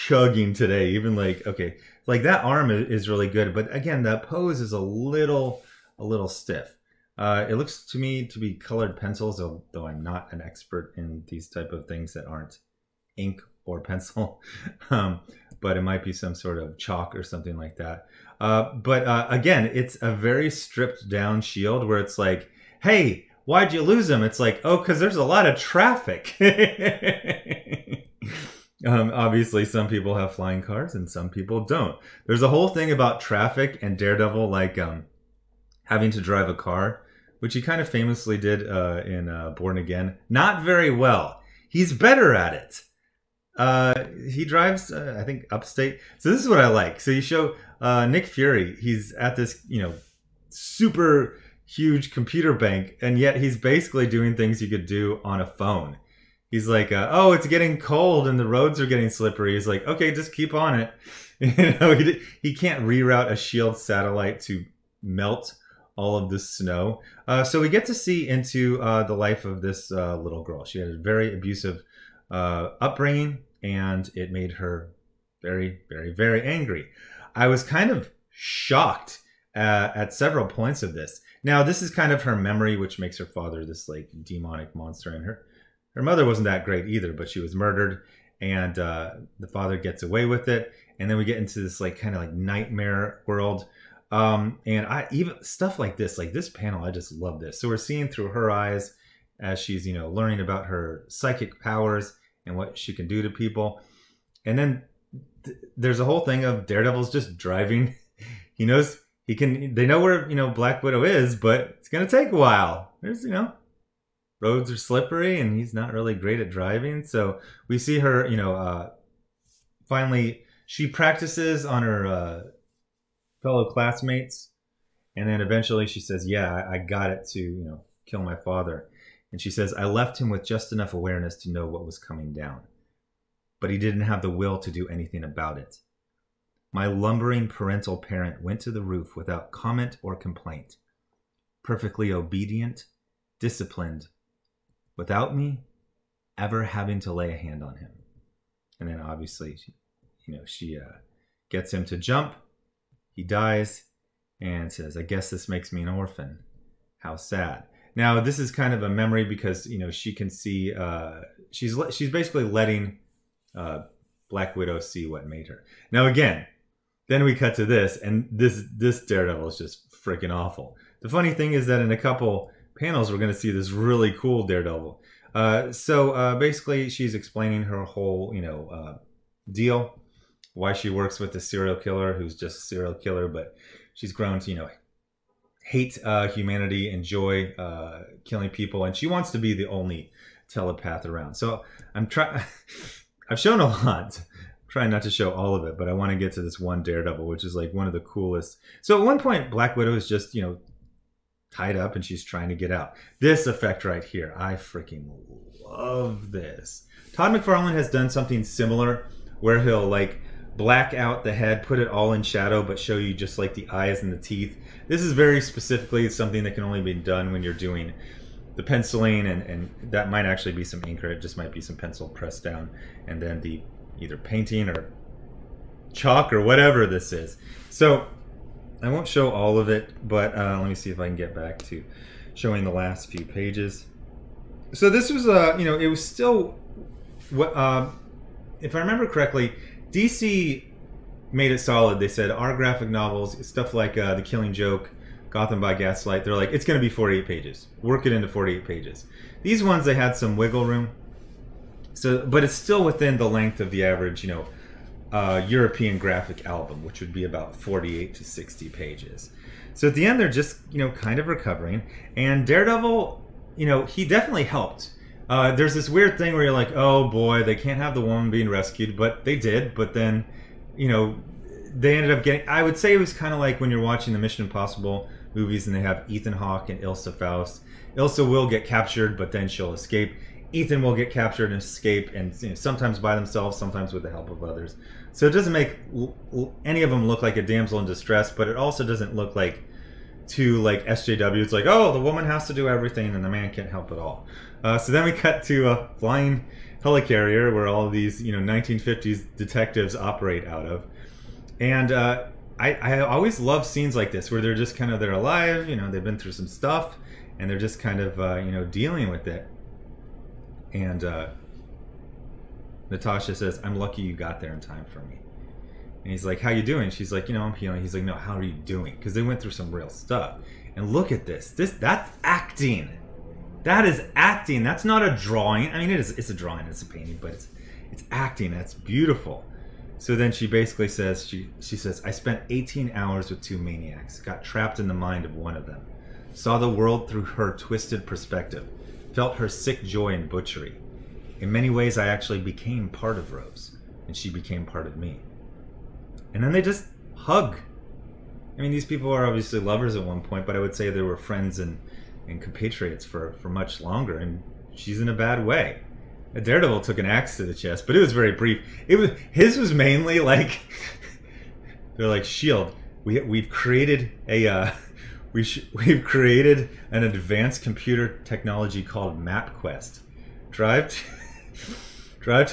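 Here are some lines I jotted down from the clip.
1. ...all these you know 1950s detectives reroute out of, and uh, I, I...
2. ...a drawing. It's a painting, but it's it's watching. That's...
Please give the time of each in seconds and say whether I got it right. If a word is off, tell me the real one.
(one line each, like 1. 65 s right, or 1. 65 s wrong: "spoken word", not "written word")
1. 297 s wrong: "operate", not "reroute"
2. 326 s wrong: "acting", not "watching".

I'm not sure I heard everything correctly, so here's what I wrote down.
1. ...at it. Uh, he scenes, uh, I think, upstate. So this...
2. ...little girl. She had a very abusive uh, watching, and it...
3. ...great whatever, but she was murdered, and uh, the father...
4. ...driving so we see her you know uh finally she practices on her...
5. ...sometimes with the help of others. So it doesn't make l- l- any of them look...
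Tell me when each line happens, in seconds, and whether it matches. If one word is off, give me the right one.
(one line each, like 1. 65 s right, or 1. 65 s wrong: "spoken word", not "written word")
1. 42 s wrong: "drives", not "scenes"
2. 70 s wrong: "upbringing", not "watching"
3. 86 s wrong: "either", not "whatever"
4. 116 s right
5. 283 s right.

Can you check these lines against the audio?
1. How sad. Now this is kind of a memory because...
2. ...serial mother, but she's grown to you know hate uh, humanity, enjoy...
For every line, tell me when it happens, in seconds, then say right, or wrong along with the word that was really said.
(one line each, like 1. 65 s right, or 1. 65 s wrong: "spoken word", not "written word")
1. 156 s right
2. 182 s wrong: "killer", not "mother".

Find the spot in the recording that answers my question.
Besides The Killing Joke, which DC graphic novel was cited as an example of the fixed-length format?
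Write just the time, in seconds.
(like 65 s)
245 s.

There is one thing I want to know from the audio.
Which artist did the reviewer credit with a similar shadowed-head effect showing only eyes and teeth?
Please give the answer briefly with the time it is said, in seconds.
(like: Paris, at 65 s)
Todd McFarlane, at 207 s.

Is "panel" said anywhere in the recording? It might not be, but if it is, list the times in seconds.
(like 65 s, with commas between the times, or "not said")
96 s, 172 s.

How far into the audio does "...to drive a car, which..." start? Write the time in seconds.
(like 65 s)
36 s.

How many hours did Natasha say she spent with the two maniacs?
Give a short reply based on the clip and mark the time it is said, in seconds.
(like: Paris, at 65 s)
18, at 332 s.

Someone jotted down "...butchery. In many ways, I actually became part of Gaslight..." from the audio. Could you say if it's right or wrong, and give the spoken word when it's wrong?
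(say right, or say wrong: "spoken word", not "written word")
wrong: "Rose", not "Gaslight".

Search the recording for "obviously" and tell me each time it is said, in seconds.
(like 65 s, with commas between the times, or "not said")
29 s, 149 s, 349 s.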